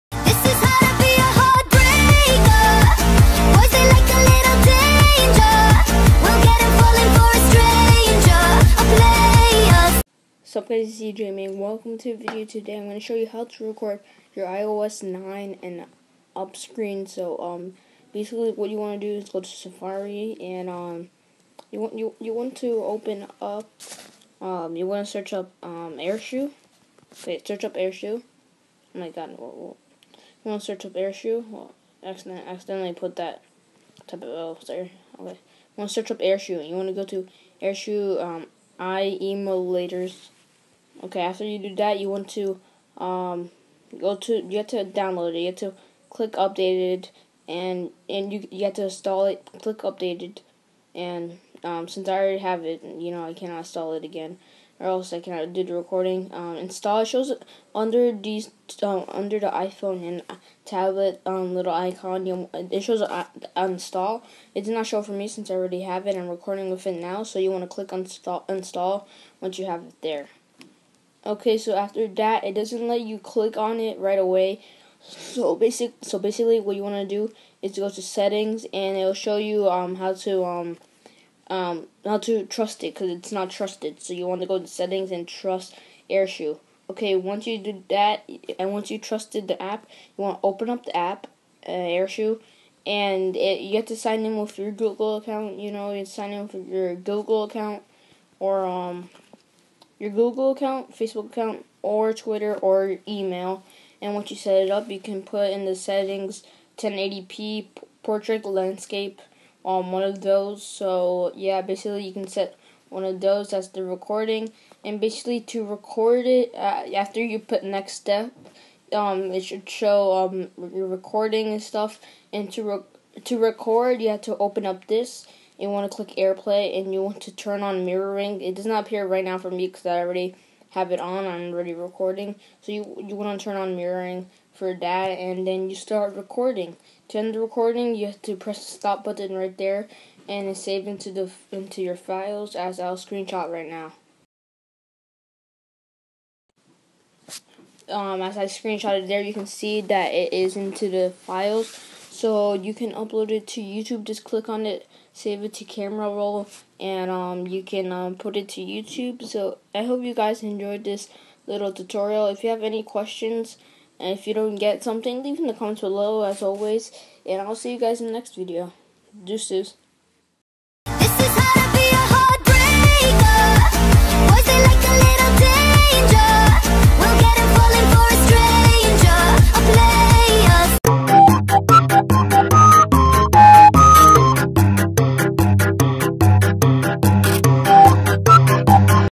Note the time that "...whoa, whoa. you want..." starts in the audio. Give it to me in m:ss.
0:29.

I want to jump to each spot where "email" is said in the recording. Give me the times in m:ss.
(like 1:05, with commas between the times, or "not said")
1:43.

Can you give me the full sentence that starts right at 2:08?
It does not appear right now for me because I already have it on.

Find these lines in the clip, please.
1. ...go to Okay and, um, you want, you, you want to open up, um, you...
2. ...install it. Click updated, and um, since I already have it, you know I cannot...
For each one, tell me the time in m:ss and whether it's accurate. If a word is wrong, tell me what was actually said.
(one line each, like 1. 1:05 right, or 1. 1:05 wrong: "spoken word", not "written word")
1. 0:19 wrong: "Safari", not "Okay"
2. 0:48 right.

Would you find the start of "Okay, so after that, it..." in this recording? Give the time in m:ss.
1:11.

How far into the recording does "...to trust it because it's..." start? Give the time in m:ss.
1:22.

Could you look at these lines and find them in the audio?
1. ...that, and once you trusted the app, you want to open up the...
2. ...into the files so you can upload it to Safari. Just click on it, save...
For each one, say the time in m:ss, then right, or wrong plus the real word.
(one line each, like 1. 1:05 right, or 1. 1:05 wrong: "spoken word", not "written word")
1. 1:27 right
2. 2:30 wrong: "YouTube", not "Safari".